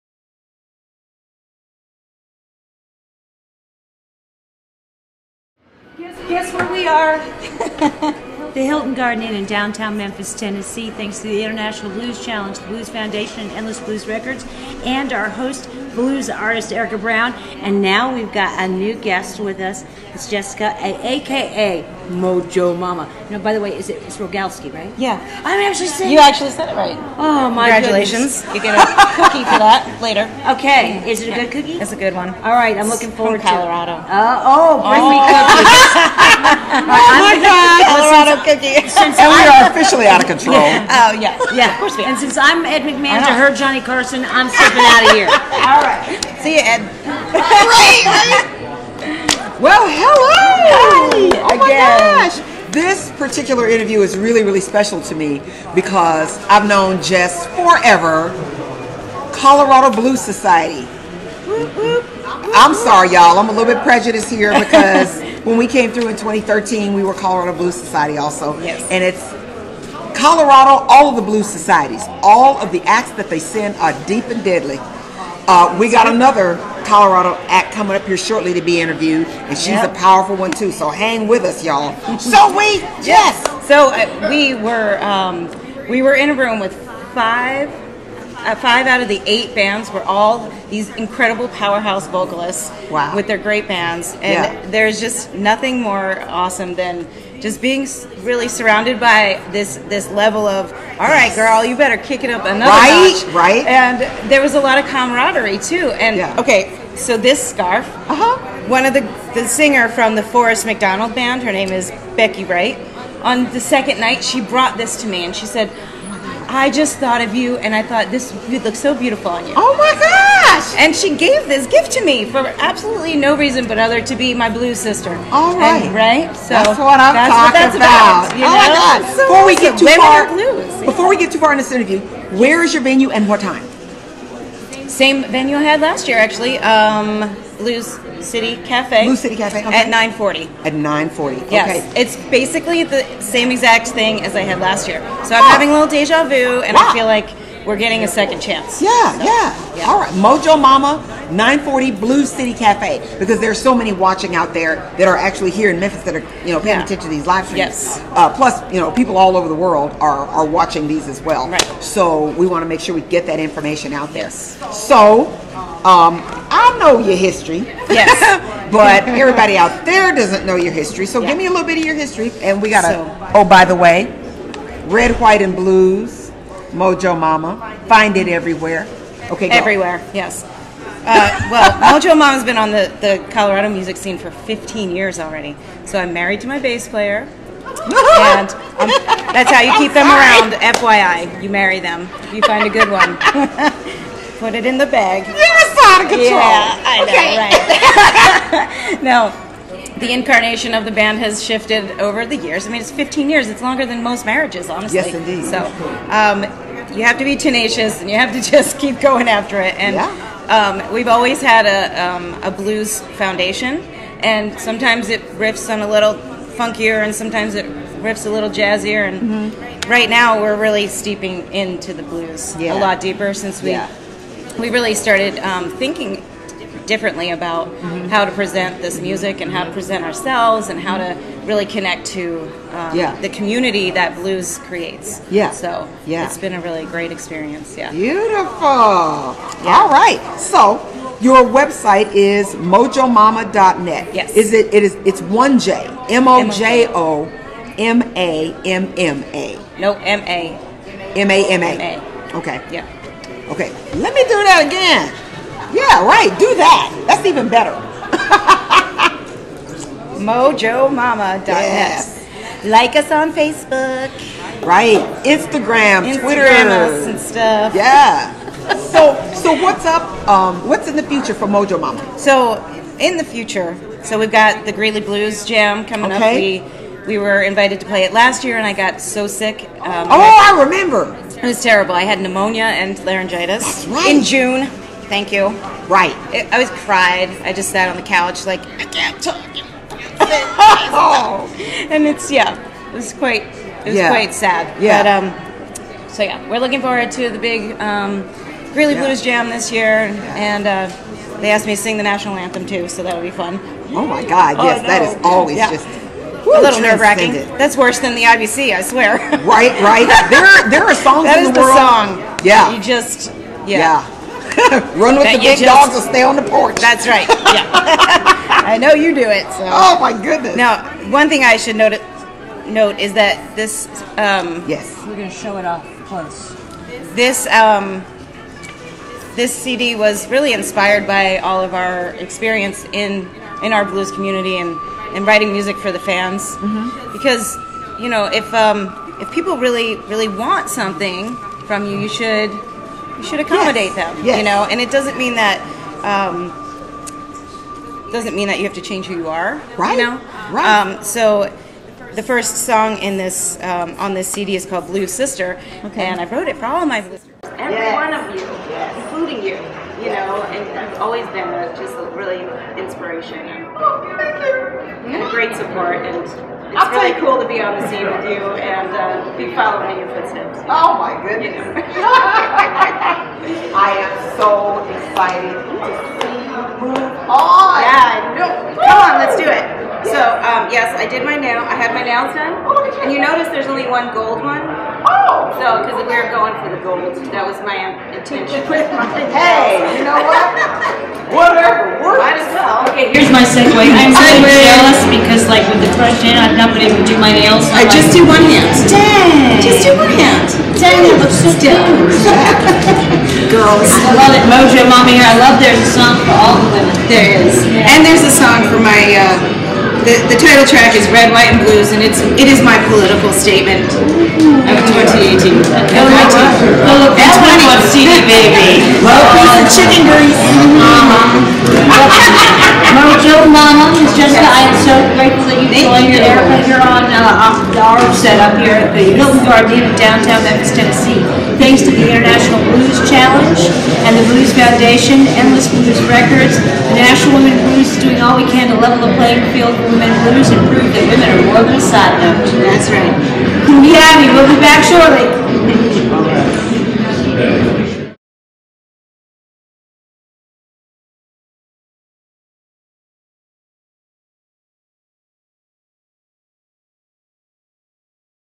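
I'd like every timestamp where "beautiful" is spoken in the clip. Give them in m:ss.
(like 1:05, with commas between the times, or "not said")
1:58, 3:57.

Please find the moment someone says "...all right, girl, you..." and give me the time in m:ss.
1:40.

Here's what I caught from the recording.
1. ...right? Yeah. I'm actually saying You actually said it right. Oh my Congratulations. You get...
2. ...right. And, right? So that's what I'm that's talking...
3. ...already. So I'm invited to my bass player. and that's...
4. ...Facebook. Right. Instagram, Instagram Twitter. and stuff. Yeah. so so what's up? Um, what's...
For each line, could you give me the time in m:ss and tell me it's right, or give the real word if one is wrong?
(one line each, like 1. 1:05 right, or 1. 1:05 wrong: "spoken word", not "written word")
1. 0:24 right
2. 2:05 right
3. 3:05 wrong: "married", not "invited"
4. 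4:23 right.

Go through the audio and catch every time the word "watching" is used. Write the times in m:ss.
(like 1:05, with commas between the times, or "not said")
2:33, 2:40.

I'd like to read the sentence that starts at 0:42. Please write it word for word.
And since I'm Ed McMahon to her Johnny Carson, I'm stepping out of here.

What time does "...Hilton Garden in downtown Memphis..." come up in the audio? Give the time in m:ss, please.
7:09.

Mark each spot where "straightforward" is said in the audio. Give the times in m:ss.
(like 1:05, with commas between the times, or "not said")
not said.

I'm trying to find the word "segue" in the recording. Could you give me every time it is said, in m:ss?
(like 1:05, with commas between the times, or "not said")
6:33.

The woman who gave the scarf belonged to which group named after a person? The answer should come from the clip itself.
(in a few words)
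Forrest McDonald band.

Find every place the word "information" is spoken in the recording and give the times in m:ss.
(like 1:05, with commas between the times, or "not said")
2:43.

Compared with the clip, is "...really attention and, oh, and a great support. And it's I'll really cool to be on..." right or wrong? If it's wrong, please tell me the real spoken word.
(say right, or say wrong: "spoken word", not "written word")
wrong: "inspiration", not "attention".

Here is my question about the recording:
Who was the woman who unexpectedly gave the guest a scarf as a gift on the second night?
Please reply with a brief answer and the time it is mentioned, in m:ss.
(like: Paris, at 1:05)
Becky Wright, at 1:52.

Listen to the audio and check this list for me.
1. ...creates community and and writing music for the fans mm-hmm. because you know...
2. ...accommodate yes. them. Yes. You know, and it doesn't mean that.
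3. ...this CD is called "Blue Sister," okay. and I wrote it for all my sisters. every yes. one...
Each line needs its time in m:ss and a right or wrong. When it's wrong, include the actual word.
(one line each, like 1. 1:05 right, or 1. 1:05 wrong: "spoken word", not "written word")
1. 5:33 wrong: "blues", not "creates"
2. 5:43 right
3. 5:54 right.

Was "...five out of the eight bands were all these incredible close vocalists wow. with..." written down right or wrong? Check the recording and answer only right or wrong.
wrong.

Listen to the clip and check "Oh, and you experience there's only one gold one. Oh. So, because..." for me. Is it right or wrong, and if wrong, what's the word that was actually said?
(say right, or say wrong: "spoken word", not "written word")
wrong: "notice", not "experience".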